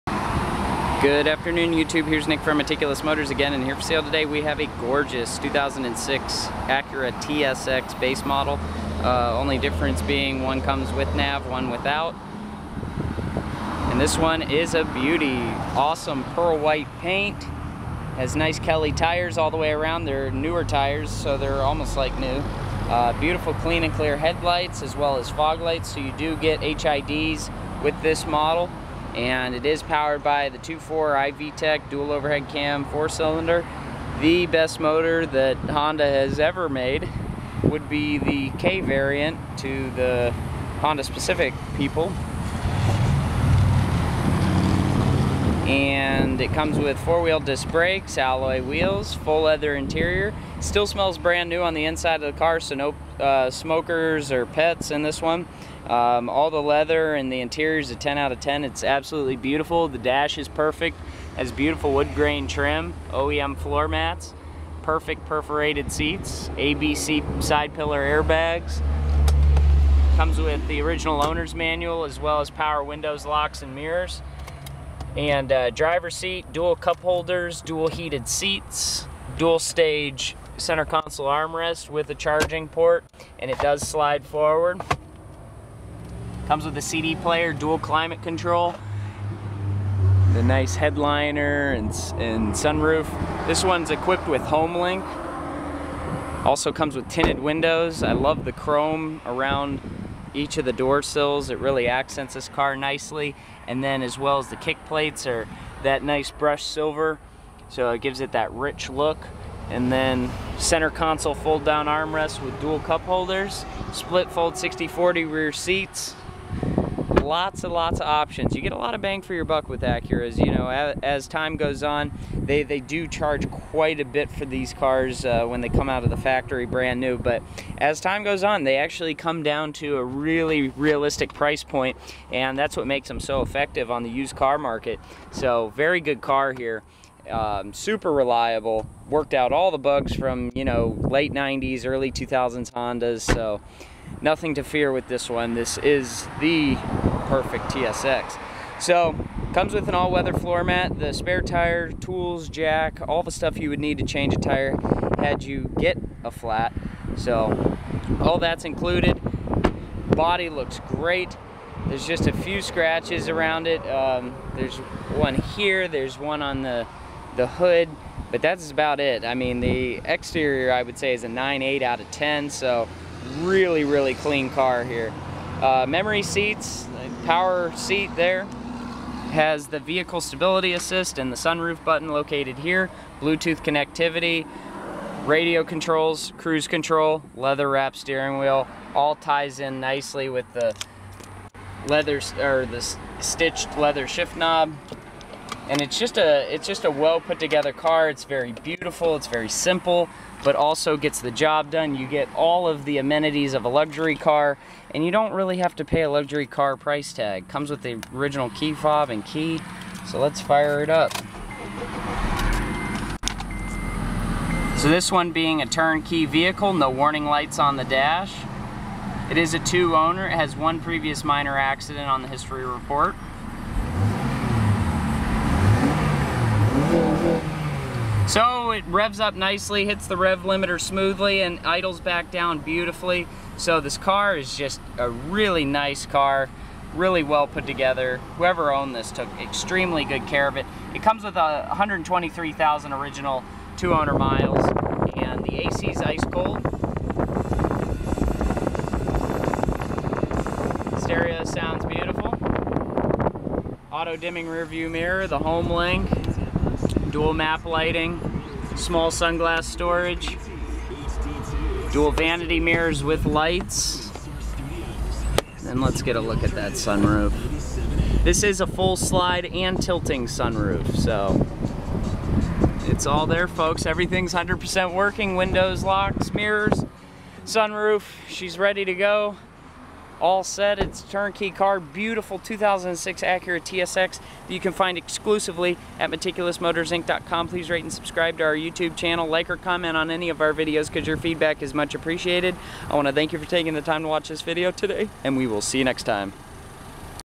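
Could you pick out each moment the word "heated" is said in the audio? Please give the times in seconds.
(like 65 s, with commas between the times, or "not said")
77 s.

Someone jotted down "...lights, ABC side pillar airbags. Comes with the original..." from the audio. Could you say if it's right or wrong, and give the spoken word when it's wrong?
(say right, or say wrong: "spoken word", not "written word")
wrong: "seats", not "lights".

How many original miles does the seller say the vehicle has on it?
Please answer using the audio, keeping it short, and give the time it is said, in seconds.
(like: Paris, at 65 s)
123,000, at 241 s.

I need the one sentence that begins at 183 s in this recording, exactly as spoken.
Bluetooth connectivity, radio controls, cruise control, leather wrap steering wheel.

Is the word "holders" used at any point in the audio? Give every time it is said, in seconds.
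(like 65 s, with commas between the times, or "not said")
77 s, 113 s.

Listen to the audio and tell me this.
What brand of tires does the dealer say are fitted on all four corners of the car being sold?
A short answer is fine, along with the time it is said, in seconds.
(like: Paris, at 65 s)
Kelly, at 18 s.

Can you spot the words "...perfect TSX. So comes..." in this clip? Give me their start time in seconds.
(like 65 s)
147 s.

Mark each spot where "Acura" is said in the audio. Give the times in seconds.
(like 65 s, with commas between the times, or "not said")
6 s, 119 s, 283 s.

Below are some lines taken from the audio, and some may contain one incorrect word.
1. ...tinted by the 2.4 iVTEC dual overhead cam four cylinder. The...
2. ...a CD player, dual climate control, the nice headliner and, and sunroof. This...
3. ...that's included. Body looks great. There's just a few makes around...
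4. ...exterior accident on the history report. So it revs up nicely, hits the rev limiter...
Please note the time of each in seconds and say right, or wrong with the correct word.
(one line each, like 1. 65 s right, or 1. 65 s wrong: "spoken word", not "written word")
1. 29 s wrong: "powered", not "tinted"
2. 86 s right
3. 158 s wrong: "scratches", not "makes"
4. 221 s wrong: "minor", not "exterior".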